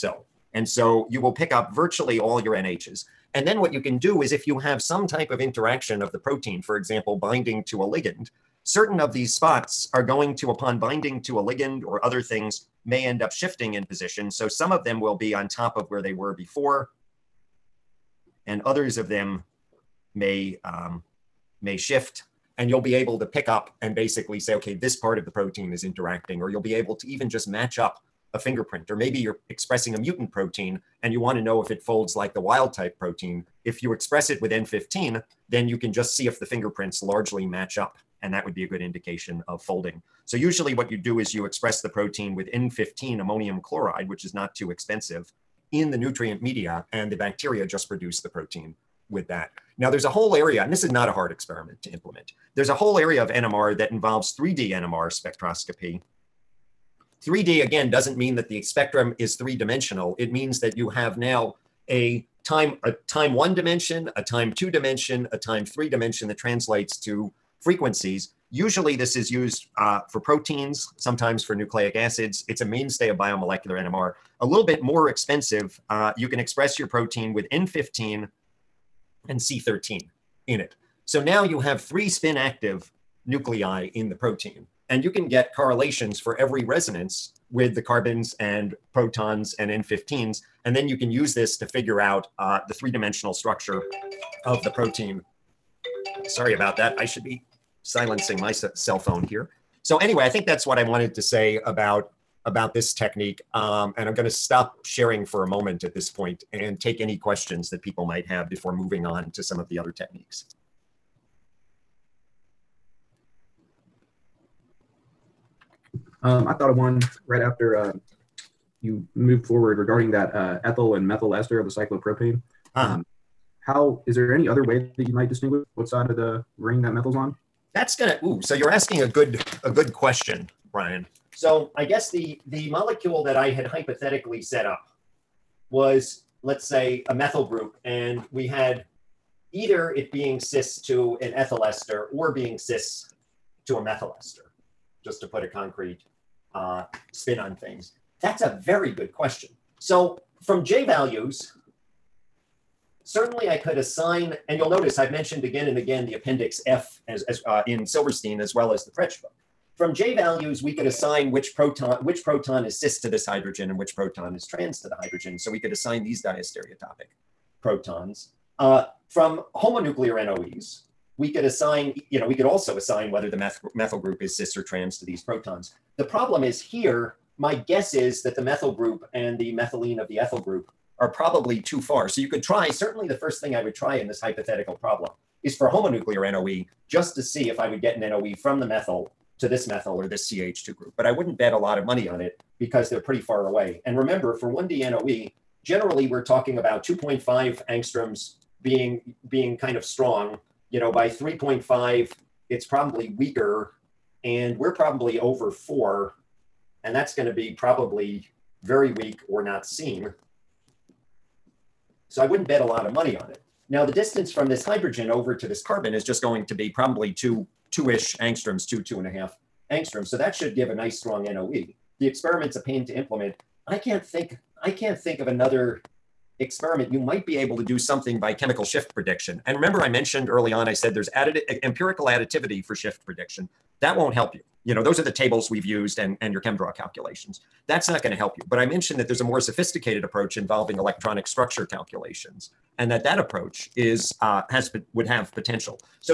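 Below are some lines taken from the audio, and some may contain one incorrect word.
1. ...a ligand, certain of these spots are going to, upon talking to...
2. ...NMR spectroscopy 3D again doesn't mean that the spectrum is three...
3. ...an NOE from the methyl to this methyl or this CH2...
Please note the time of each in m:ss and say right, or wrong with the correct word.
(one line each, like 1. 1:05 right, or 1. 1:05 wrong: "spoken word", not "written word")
1. 0:07 wrong: "binding", not "talking"
2. 0:54 right
3. 3:07 right.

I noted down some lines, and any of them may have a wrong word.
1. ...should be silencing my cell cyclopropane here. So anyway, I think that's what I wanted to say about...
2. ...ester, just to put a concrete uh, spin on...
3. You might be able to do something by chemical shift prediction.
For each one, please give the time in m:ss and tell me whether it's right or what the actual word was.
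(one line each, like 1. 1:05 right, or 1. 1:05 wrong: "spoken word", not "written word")
1. 1:37 wrong: "phone", not "cyclopropane"
2. 2:24 right
3. 3:46 right.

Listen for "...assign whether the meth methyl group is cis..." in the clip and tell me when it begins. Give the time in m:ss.
2:52.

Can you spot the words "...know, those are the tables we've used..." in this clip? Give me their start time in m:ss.
3:54.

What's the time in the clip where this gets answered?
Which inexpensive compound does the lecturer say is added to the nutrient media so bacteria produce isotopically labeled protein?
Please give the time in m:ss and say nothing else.
0:42.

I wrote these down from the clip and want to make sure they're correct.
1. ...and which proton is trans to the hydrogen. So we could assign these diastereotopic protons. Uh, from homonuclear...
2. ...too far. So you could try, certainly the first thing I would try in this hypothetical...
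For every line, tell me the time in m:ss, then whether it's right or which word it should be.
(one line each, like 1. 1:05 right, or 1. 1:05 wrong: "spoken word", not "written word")
1. 2:43 right
2. 3:01 right.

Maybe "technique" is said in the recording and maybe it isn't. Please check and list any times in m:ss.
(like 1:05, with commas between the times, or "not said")
1:42, 1:49.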